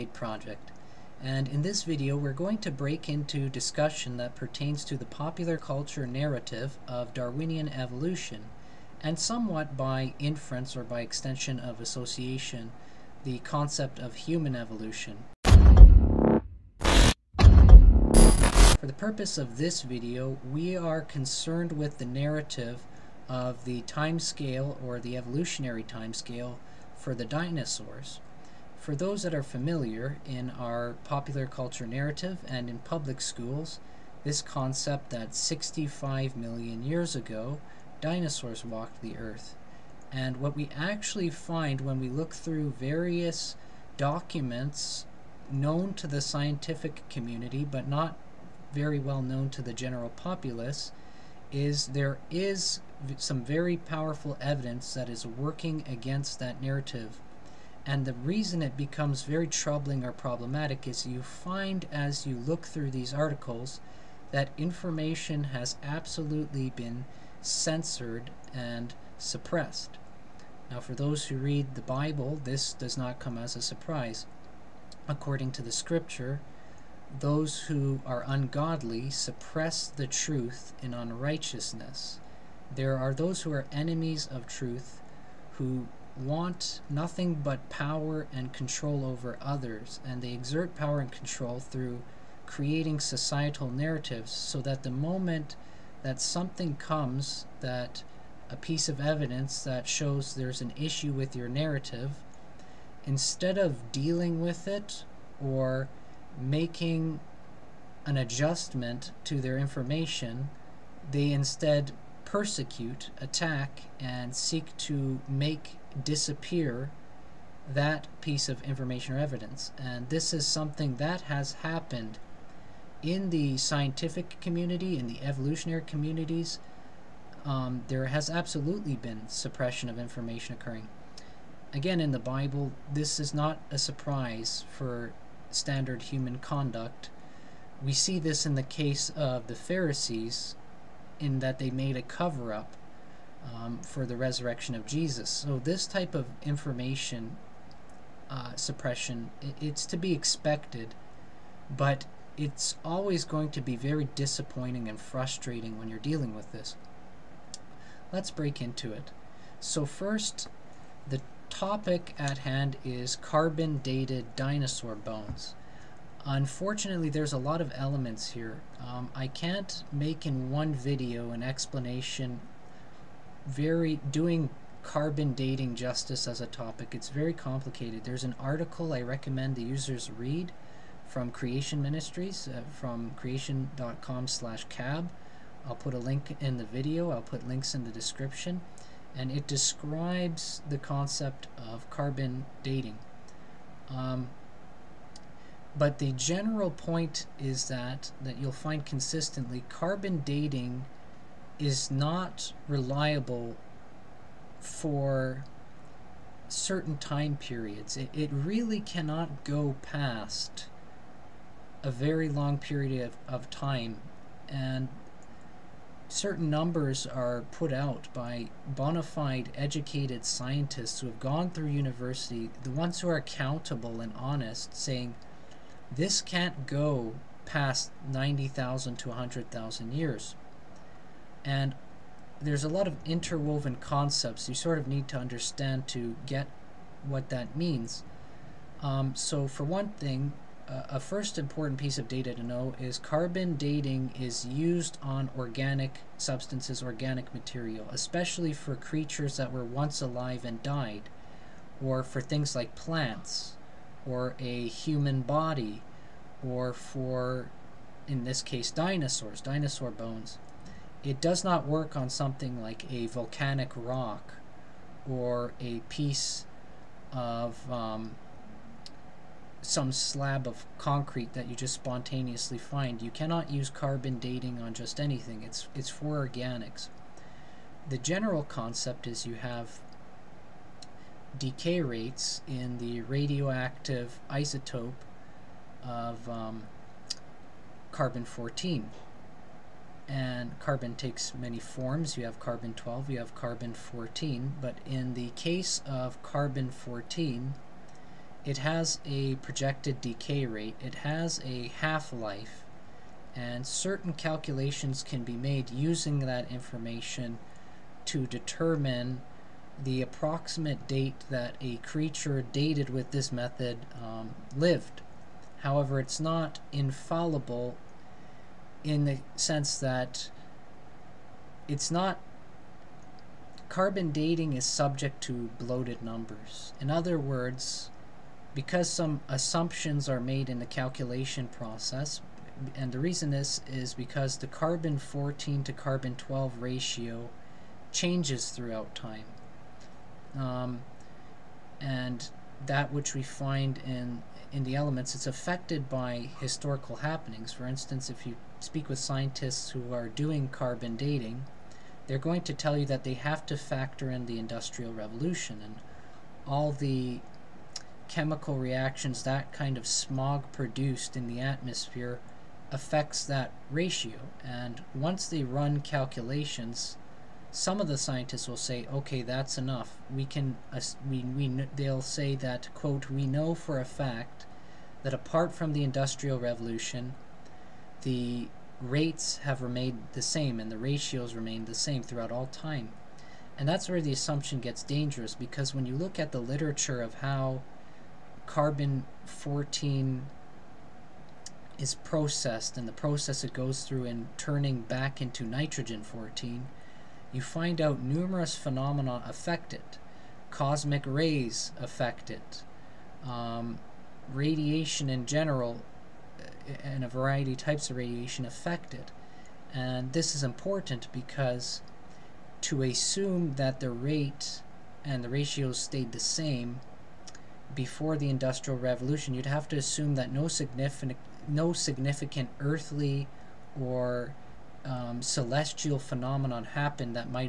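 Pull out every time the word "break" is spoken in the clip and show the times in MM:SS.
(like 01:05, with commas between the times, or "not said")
00:02, 02:38.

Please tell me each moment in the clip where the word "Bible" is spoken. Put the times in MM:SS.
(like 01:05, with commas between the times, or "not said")
01:11, 02:12.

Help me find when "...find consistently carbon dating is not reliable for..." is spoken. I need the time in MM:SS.
03:18.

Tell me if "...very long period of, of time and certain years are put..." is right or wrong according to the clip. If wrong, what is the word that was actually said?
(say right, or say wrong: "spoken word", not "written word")
wrong: "numbers", not "years".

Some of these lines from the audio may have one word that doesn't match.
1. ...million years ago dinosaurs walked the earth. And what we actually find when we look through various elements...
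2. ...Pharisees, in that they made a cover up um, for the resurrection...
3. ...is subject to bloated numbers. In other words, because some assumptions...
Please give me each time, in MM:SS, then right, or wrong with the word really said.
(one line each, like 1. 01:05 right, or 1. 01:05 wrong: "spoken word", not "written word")
1. 00:36 wrong: "documents", not "elements"
2. 02:19 right
3. 05:24 right.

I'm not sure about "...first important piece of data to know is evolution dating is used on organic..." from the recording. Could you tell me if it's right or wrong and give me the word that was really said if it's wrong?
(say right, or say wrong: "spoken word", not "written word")
wrong: "carbon", not "evolution".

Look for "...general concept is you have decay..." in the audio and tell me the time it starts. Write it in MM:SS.
04:37.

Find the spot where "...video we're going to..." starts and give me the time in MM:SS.
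00:01.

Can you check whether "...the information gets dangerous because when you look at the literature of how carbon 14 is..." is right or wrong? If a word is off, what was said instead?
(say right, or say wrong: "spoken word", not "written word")
wrong: "assumption", not "information".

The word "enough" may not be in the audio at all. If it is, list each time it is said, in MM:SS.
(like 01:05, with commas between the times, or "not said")
06:09.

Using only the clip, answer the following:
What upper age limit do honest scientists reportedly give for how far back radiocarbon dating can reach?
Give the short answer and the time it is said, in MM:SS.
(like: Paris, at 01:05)
90,000 to 100,000 years, at 03:48.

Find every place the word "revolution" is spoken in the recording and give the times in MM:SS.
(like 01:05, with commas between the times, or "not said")
05:54, 06:16, 06:58.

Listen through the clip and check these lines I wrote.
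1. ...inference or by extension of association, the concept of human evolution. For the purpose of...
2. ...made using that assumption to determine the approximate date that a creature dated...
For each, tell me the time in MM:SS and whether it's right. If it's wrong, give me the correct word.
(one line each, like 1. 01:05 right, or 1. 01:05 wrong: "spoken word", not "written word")
1. 00:10 right
2. 05:05 wrong: "information", not "assumption".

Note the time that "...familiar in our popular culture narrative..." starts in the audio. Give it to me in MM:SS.
00:29.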